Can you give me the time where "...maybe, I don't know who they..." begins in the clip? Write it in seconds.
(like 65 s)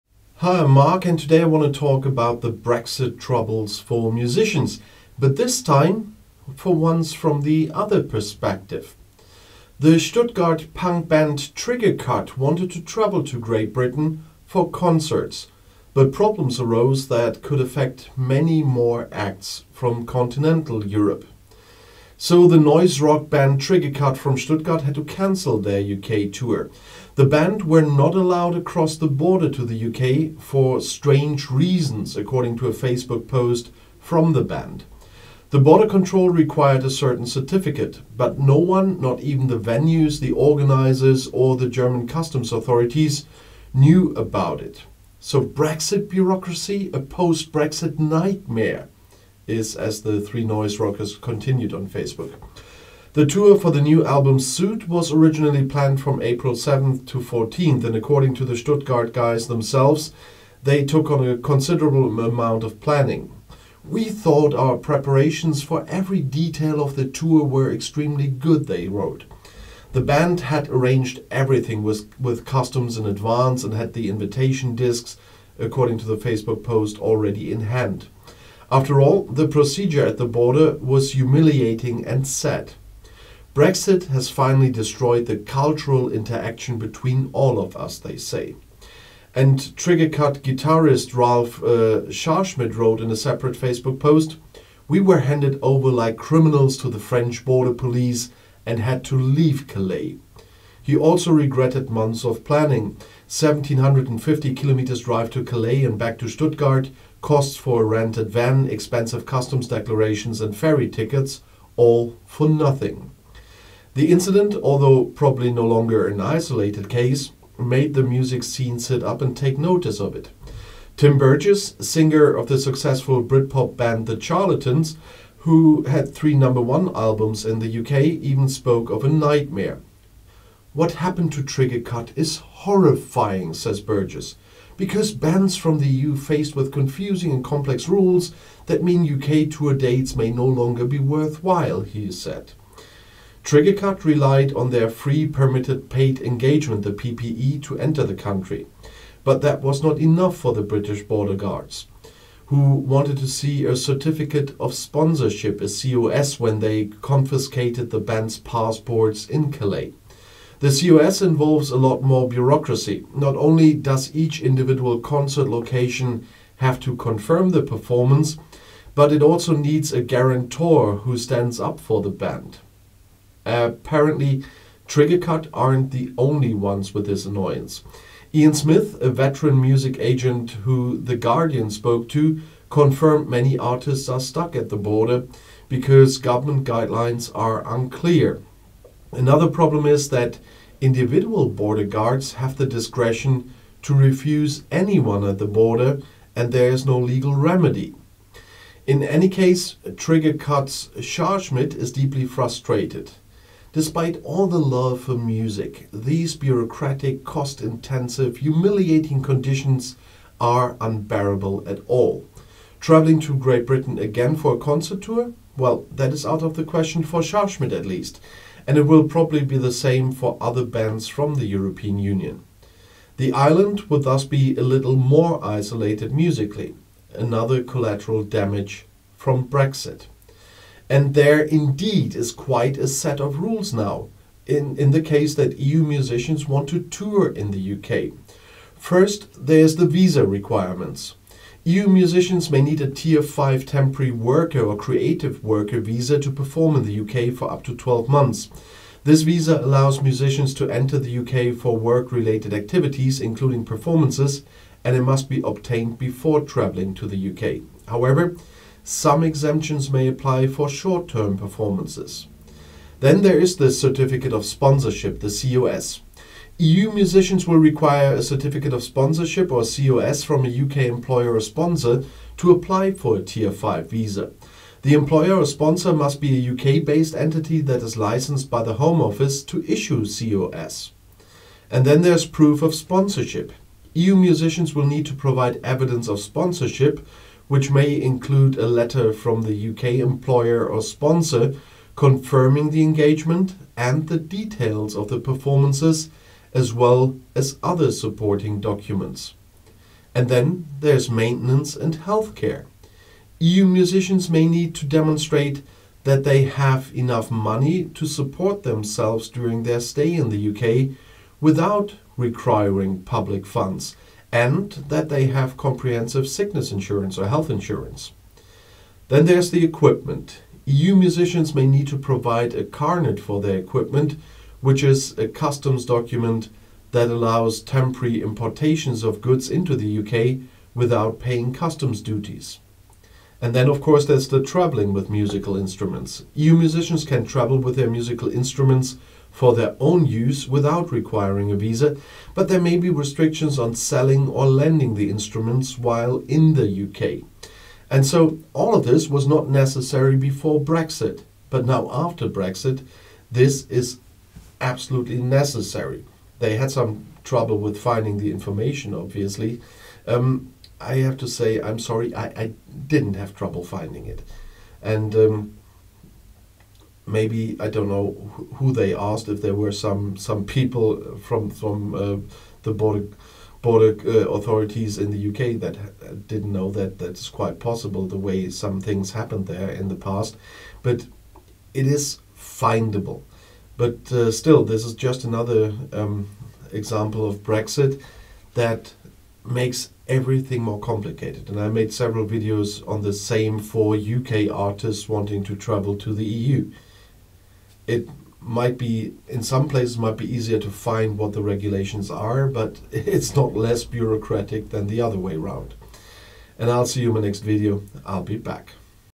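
367 s.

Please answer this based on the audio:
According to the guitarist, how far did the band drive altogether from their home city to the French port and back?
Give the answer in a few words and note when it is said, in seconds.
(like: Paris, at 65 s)
1750 kilometers, at 103 s.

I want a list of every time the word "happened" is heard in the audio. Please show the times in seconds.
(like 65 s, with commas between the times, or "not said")
130 s, 379 s.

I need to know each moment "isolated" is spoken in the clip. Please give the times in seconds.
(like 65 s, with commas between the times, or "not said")
116 s, 225 s.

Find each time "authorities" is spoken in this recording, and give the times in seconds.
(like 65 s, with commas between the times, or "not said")
42 s, 374 s.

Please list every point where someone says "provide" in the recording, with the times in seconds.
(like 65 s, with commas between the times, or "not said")
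285 s, 321 s.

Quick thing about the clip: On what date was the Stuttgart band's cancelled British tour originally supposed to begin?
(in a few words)
April 7th.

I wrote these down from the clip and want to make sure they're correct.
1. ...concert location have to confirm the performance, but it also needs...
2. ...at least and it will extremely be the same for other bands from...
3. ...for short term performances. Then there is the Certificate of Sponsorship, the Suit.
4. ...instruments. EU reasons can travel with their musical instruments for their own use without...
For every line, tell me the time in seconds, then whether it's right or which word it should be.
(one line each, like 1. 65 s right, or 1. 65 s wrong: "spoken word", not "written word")
1. 164 s right
2. 217 s wrong: "probably", not "extremely"
3. 260 s wrong: "COS", not "Suit"
4. 335 s wrong: "musicians", not "reasons".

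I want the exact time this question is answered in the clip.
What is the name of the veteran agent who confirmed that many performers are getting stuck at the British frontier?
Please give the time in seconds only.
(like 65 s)
178 s.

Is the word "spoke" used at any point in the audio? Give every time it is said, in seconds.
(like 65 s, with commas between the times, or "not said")
128 s, 181 s.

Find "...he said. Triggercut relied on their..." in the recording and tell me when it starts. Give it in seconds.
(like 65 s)
141 s.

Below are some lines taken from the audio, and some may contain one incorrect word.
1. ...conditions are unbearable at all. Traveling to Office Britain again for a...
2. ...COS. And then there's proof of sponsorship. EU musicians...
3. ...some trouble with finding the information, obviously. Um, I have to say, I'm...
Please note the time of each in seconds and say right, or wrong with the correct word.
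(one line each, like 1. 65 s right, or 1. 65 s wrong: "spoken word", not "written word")
1. 209 s wrong: "Great", not "Office"
2. 280 s right
3. 356 s right.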